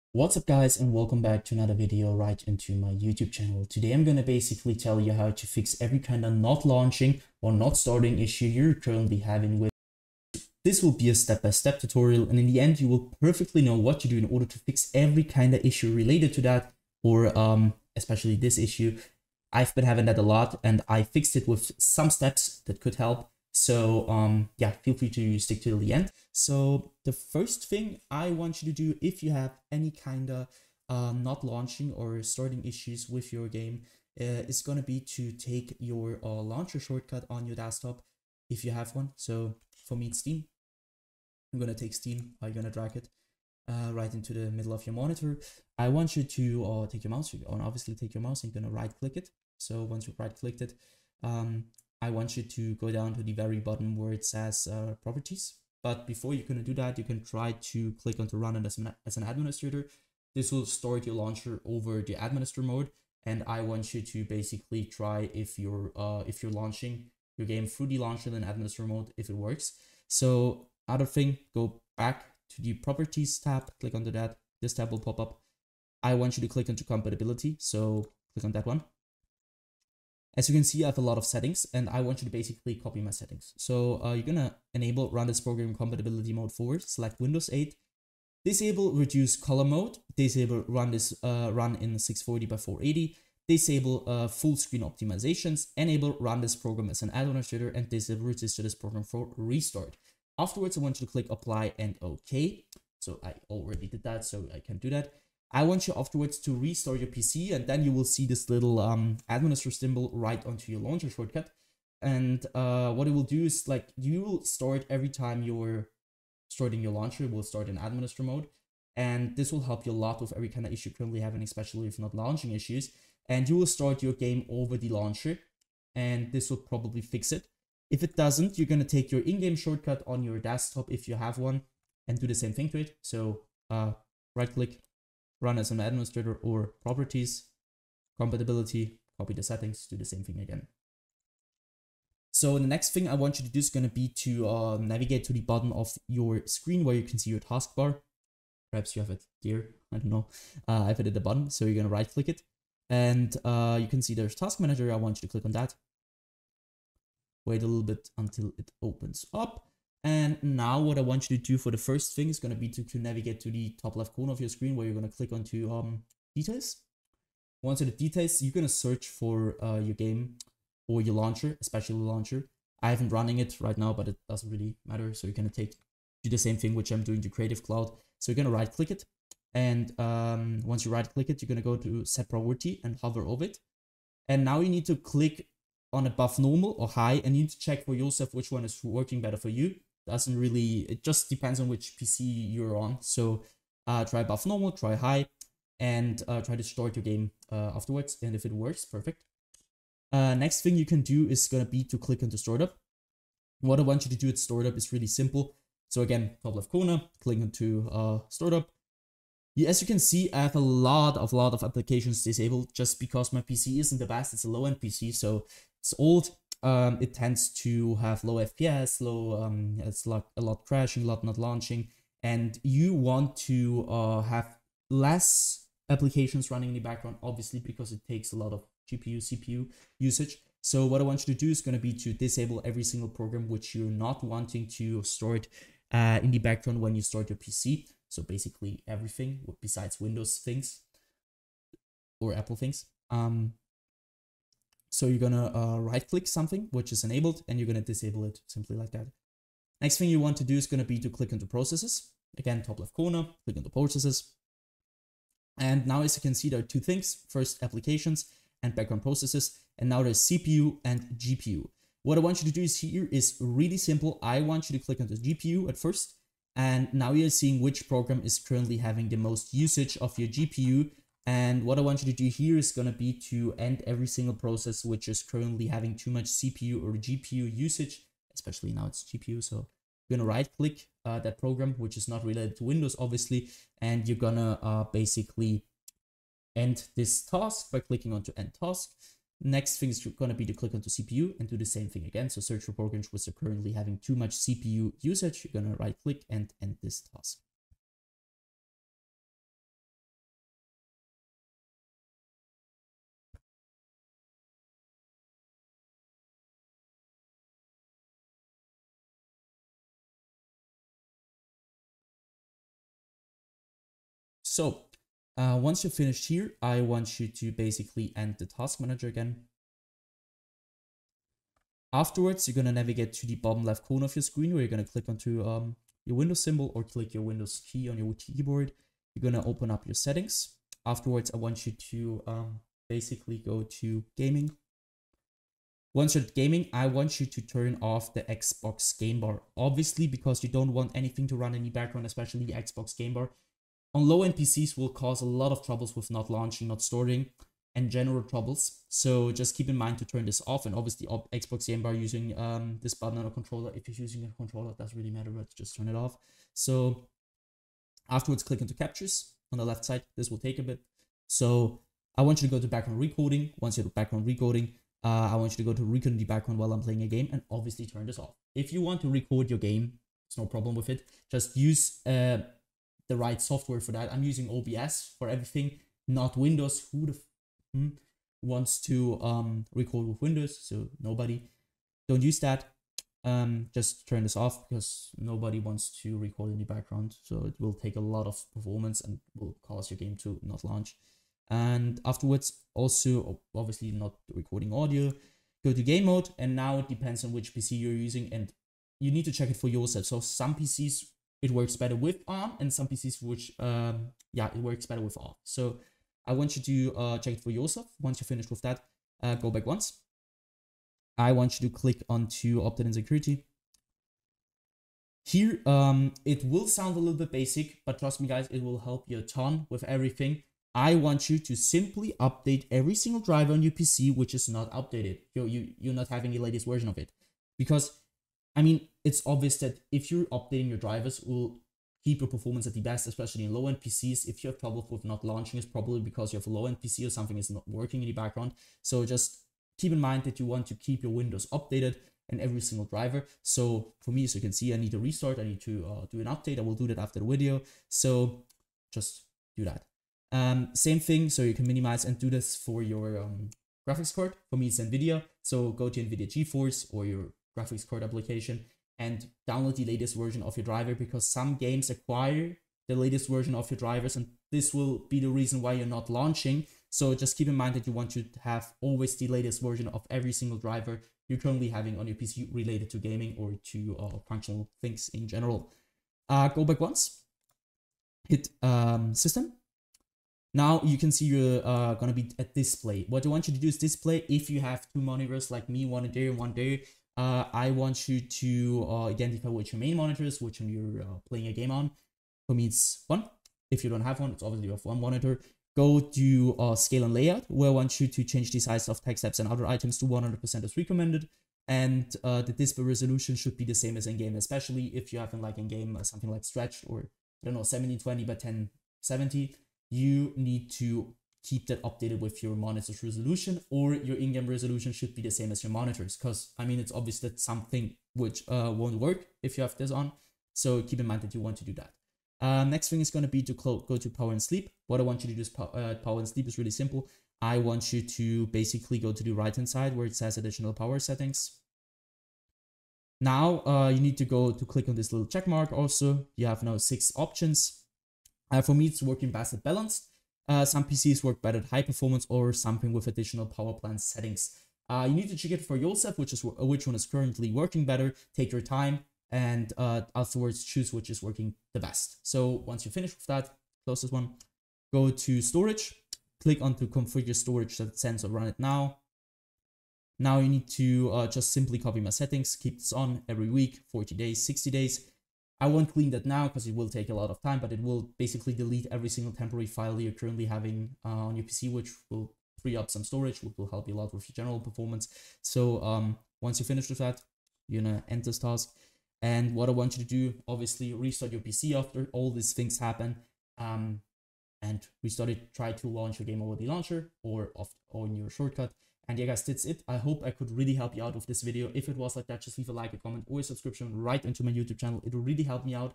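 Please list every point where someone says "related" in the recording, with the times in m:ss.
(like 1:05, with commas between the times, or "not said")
0:15, 4:42, 7:52.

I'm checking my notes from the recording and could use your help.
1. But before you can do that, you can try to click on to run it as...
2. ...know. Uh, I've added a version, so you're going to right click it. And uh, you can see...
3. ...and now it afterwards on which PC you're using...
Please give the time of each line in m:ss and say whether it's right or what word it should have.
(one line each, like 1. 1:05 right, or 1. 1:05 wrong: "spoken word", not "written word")
1. 0:55 right
2. 2:30 wrong: "button", not "version"
3. 6:36 wrong: "depends", not "afterwards".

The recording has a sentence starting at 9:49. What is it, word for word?
I hope I could really help you out with this video.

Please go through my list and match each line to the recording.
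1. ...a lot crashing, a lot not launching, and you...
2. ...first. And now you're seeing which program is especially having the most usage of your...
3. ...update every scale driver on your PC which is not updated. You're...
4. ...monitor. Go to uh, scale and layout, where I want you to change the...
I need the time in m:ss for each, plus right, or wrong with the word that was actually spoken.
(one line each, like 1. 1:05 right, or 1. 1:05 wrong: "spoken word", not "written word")
1. 3:40 right
2. 4:25 wrong: "currently", not "especially"
3. 7:02 wrong: "single", not "scale"
4. 8:15 right.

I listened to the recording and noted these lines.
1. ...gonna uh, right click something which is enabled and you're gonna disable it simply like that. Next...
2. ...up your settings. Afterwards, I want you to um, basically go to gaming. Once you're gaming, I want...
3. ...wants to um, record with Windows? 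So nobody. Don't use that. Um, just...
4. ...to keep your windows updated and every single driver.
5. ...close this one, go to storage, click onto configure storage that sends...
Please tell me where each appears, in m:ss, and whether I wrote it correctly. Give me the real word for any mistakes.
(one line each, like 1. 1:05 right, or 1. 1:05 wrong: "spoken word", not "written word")
1. 4:05 right
2. 5:29 right
3. 6:18 right
4. 7:20 right
5. 9:13 right.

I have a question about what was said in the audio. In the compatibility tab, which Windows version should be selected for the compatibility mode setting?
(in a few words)
Windows 8.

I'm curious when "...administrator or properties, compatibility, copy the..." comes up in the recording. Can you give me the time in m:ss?
2:15.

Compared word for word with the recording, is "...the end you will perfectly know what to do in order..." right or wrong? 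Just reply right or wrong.
right.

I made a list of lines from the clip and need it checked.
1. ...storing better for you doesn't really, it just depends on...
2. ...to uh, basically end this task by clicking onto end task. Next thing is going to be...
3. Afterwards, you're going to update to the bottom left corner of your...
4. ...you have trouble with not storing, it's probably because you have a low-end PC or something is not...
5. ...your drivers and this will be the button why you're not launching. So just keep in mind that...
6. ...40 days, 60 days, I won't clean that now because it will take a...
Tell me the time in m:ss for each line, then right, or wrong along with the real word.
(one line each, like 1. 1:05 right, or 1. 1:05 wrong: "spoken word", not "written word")
1. 3:08 wrong: "working", not "storing"
2. 4:44 right
3. 5:21 wrong: "navigate", not "update"
4. 7:14 wrong: "launching", not "storing"
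5. 7:43 wrong: "reason", not "button"
6. 9:23 right.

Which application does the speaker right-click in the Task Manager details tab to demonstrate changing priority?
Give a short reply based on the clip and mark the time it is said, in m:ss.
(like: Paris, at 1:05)
Creative Cloud, at 2:57.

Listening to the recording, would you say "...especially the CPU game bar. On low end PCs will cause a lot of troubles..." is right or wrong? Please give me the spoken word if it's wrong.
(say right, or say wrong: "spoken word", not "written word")
wrong: "Xbox", not "CPU".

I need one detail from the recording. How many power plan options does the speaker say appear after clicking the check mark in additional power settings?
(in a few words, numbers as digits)
6.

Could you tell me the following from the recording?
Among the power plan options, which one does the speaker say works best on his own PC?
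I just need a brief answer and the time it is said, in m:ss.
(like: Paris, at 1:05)
Balanced, at 8:59.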